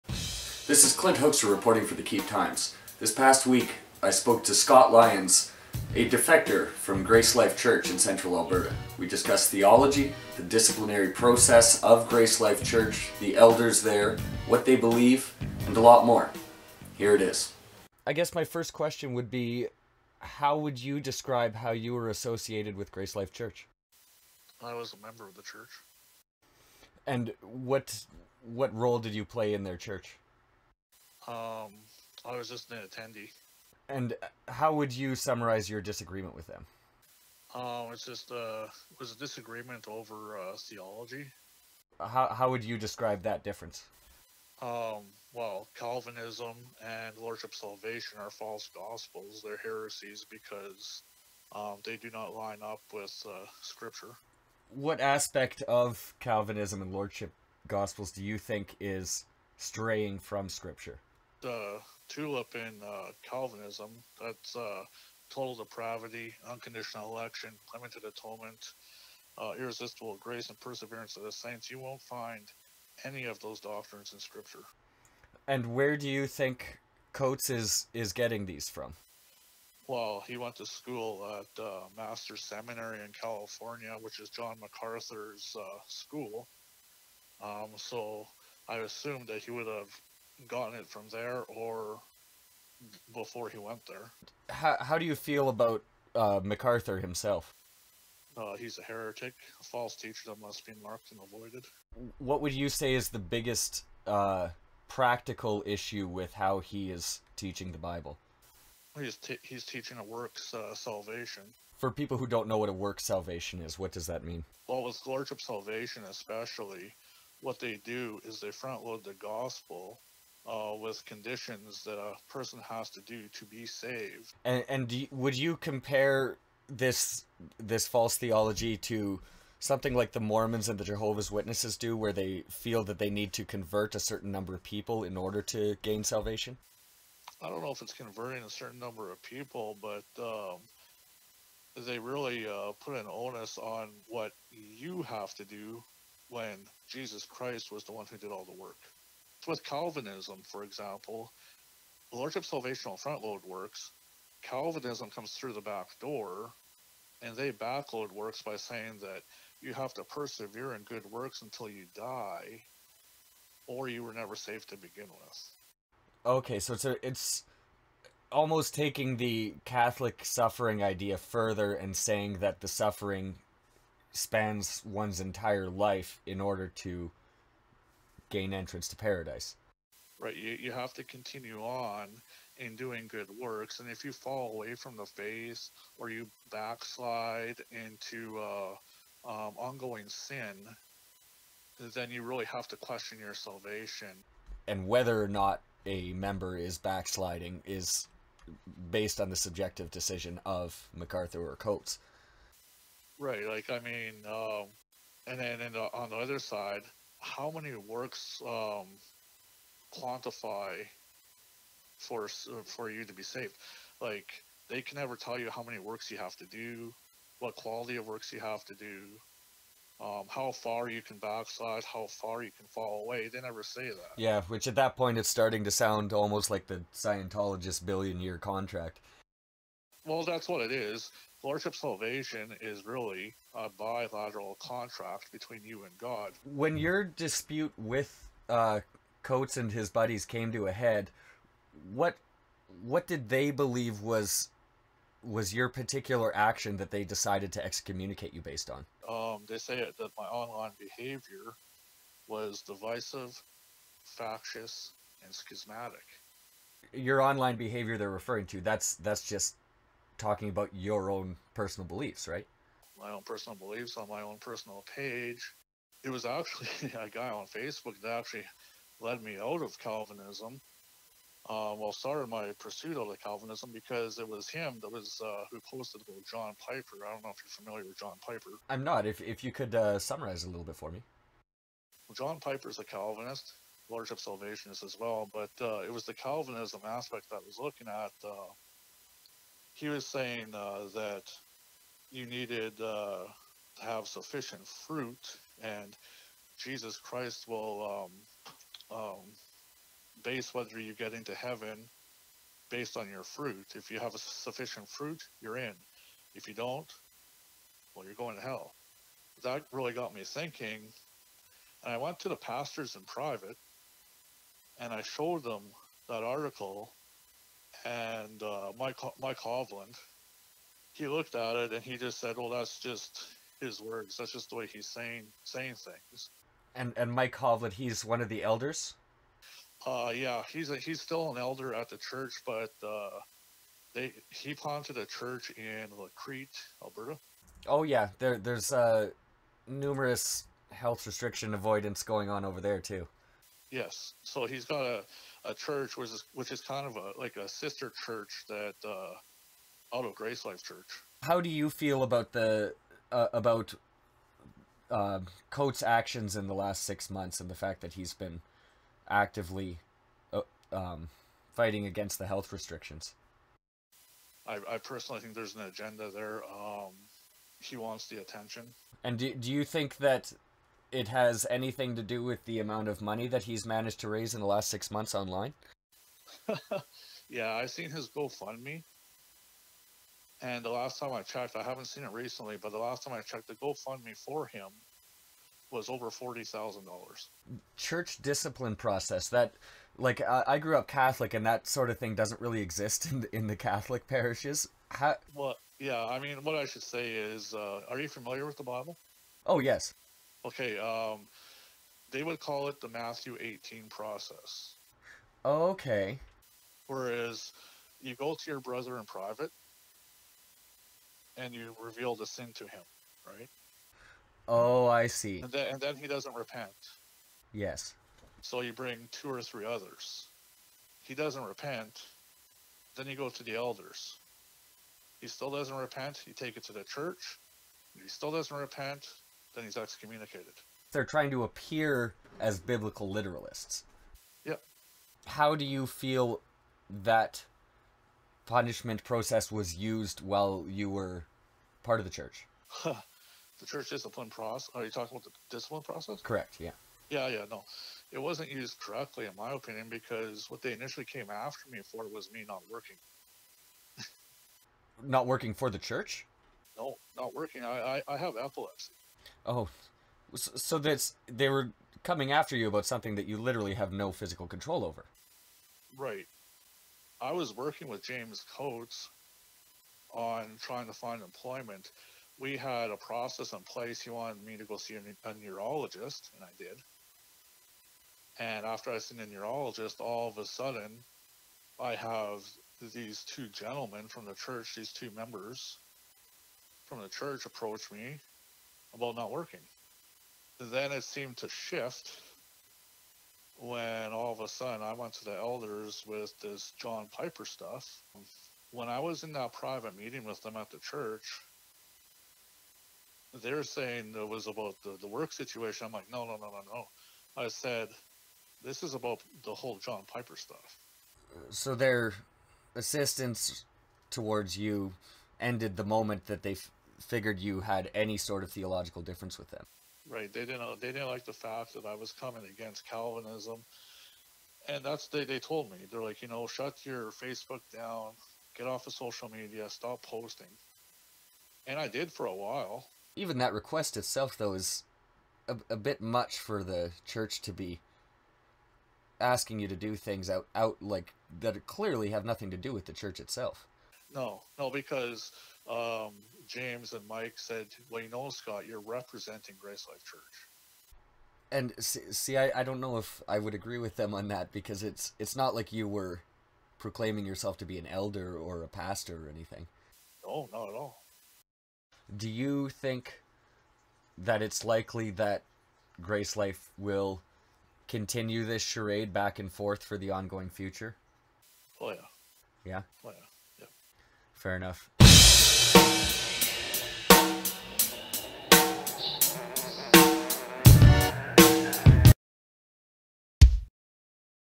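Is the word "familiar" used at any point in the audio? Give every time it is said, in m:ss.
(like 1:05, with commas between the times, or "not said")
4:37, 6:38.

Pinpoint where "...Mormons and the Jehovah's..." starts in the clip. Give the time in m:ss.
2:10.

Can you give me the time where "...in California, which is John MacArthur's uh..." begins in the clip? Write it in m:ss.
1:23.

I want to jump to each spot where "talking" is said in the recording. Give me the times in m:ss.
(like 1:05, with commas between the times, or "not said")
4:20, 7:24.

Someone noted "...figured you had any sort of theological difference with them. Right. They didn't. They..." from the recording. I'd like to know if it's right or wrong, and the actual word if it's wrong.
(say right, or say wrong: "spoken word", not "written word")
right.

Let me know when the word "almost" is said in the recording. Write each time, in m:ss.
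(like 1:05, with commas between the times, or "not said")
2:48, 3:46.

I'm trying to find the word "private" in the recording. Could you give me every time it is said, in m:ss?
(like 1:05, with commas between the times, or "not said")
5:13, 6:49, 8:19.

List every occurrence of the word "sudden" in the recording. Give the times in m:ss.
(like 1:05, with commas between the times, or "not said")
8:00, 8:14.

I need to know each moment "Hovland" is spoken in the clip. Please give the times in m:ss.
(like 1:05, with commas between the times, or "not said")
5:19, 5:27.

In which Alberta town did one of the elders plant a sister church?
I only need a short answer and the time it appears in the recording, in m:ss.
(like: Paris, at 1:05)
Crete, at 5:36.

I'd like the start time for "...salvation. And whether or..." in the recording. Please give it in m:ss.
3:13.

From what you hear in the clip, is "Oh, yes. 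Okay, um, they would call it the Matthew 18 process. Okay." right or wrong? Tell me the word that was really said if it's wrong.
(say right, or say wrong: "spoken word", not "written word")
right.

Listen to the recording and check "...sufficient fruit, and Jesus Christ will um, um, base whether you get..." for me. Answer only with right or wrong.
right.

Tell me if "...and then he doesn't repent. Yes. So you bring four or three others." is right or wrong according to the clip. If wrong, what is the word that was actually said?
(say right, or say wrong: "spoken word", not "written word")
wrong: "two", not "four".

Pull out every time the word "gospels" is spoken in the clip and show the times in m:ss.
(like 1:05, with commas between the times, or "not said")
0:48, 0:57, 1:59.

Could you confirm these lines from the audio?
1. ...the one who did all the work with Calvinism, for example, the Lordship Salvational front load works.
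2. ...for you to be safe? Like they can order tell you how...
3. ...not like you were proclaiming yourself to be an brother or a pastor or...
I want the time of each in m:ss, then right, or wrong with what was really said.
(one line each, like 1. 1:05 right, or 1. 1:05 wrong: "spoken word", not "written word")
1. 2:27 right
2. 3:32 wrong: "never", not "order"
3. 9:15 wrong: "elder", not "brother".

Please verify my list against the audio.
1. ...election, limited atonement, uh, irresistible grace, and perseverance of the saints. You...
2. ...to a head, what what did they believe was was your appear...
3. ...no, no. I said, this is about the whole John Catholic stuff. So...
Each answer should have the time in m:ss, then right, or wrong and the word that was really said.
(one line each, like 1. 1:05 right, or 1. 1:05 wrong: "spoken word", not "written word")
1. 1:07 right
2. 4:00 wrong: "particular", not "appear"
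3. 8:26 wrong: "Piper", not "Catholic".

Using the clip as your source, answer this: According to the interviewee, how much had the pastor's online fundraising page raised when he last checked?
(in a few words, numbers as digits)
$40,000.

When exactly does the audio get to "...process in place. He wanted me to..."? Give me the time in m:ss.
7:52.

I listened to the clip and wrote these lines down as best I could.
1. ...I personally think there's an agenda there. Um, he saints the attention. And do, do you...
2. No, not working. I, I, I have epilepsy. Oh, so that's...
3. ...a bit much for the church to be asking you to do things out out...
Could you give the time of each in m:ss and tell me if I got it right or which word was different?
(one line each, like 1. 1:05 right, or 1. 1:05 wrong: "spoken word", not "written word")
1. 6:04 wrong: "wants", not "saints"
2. 7:36 right
3. 8:55 right.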